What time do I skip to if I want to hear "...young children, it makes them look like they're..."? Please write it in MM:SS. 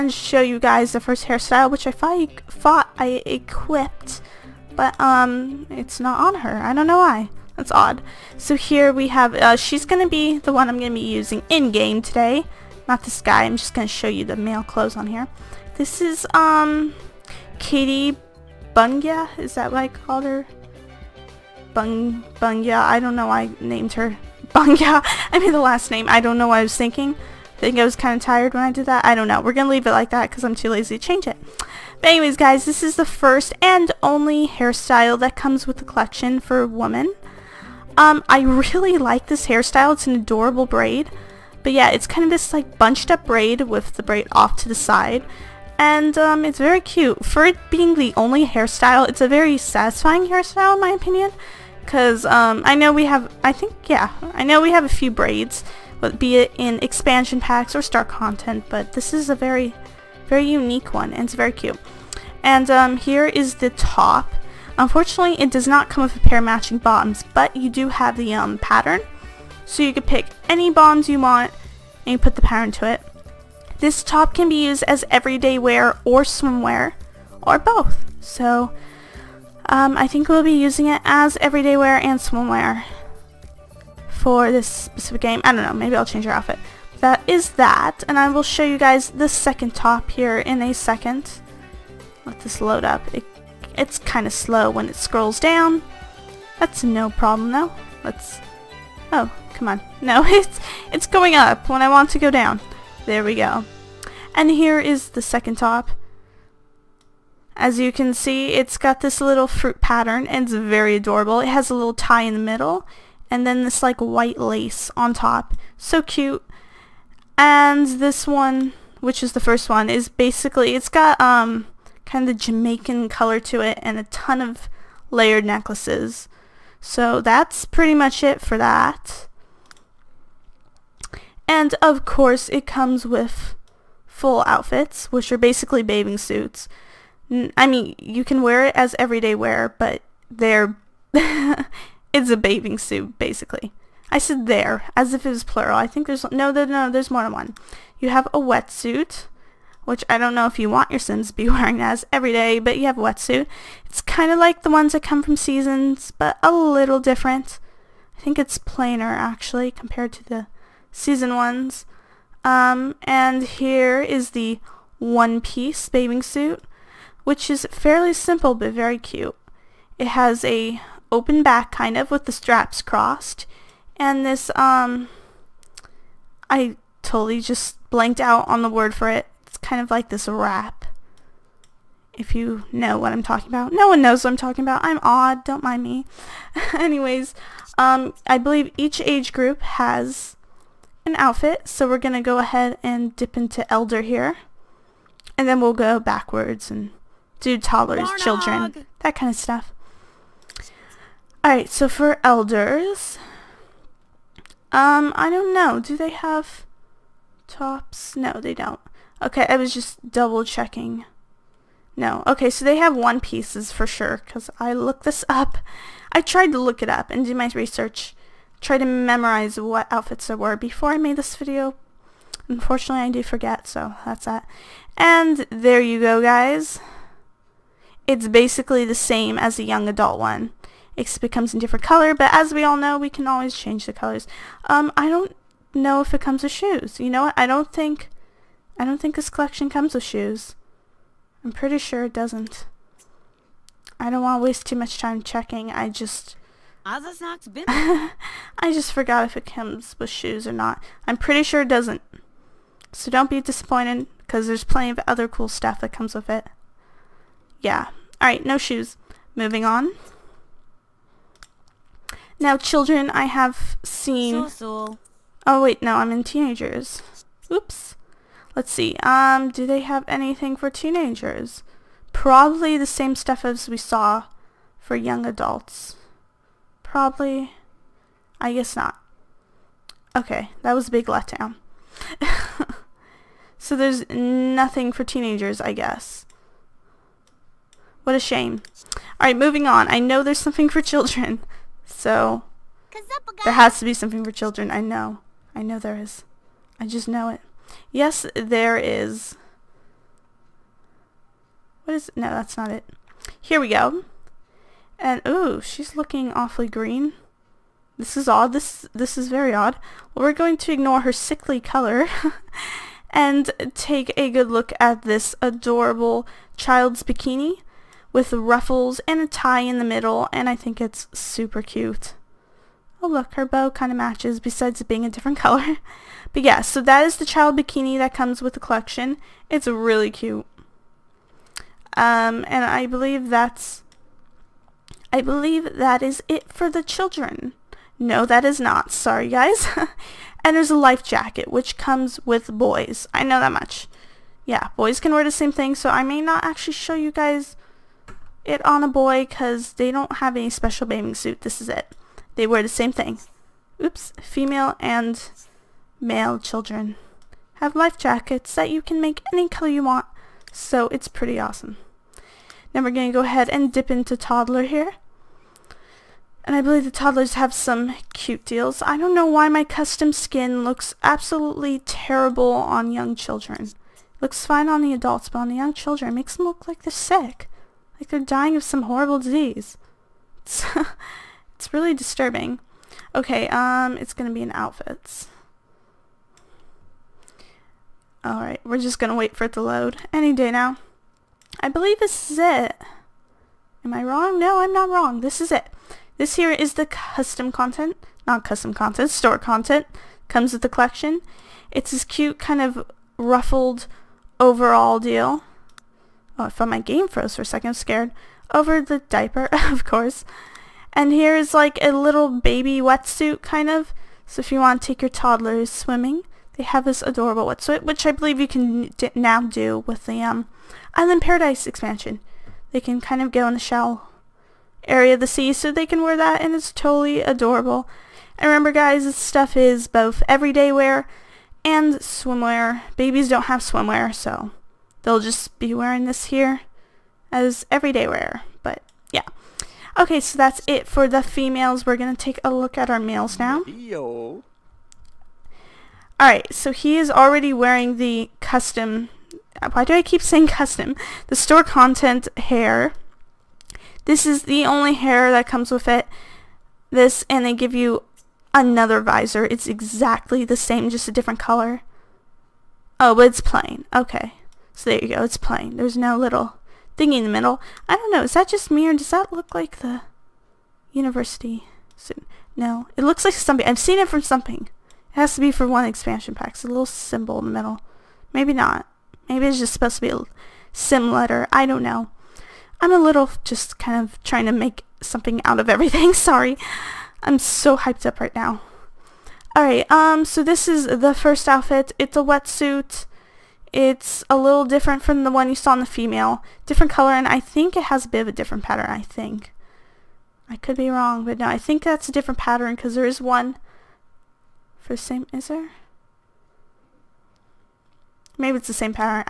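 06:15.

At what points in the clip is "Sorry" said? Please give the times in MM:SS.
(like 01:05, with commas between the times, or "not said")
05:38, 08:06.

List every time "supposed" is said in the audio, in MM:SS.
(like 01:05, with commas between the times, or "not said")
07:59.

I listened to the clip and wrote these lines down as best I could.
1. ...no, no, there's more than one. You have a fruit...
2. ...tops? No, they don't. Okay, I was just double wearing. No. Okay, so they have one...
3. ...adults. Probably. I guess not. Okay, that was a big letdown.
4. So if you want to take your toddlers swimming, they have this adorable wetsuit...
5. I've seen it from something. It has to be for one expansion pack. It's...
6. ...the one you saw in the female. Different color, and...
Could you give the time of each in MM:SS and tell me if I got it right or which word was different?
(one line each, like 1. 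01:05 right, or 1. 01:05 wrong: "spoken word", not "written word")
1. 02:26 wrong: "wetsuit", not "fruit"
2. 03:27 wrong: "checking", not "wearing"
3. 04:35 right
4. 06:54 right
5. 07:53 right
6. 08:15 right.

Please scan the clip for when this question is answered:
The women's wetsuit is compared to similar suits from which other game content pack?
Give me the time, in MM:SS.
02:35.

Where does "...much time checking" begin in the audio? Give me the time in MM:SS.
04:04.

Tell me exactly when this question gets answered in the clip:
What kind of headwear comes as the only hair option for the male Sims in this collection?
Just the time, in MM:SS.
07:39.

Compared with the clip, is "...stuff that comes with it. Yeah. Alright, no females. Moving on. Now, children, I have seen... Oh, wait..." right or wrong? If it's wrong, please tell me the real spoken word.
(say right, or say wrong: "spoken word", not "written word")
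wrong: "shoes", not "females".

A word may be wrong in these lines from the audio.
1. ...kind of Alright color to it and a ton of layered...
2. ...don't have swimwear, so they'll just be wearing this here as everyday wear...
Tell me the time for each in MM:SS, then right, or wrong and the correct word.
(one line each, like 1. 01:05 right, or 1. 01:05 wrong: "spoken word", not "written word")
1. 02:02 wrong: "Jamaican", not "Alright"
2. 07:13 right.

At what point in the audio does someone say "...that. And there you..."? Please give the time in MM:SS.
03:44.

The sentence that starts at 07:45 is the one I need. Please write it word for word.
There's no little thingy in the middle.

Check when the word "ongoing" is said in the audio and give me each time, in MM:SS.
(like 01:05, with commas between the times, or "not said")
not said.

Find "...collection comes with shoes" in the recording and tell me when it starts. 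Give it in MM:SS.
03:59.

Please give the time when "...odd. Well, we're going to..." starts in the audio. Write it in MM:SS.
05:09.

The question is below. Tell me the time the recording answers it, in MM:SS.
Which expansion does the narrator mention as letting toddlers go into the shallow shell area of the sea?
07:00.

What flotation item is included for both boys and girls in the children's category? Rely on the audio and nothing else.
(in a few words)
life jacket.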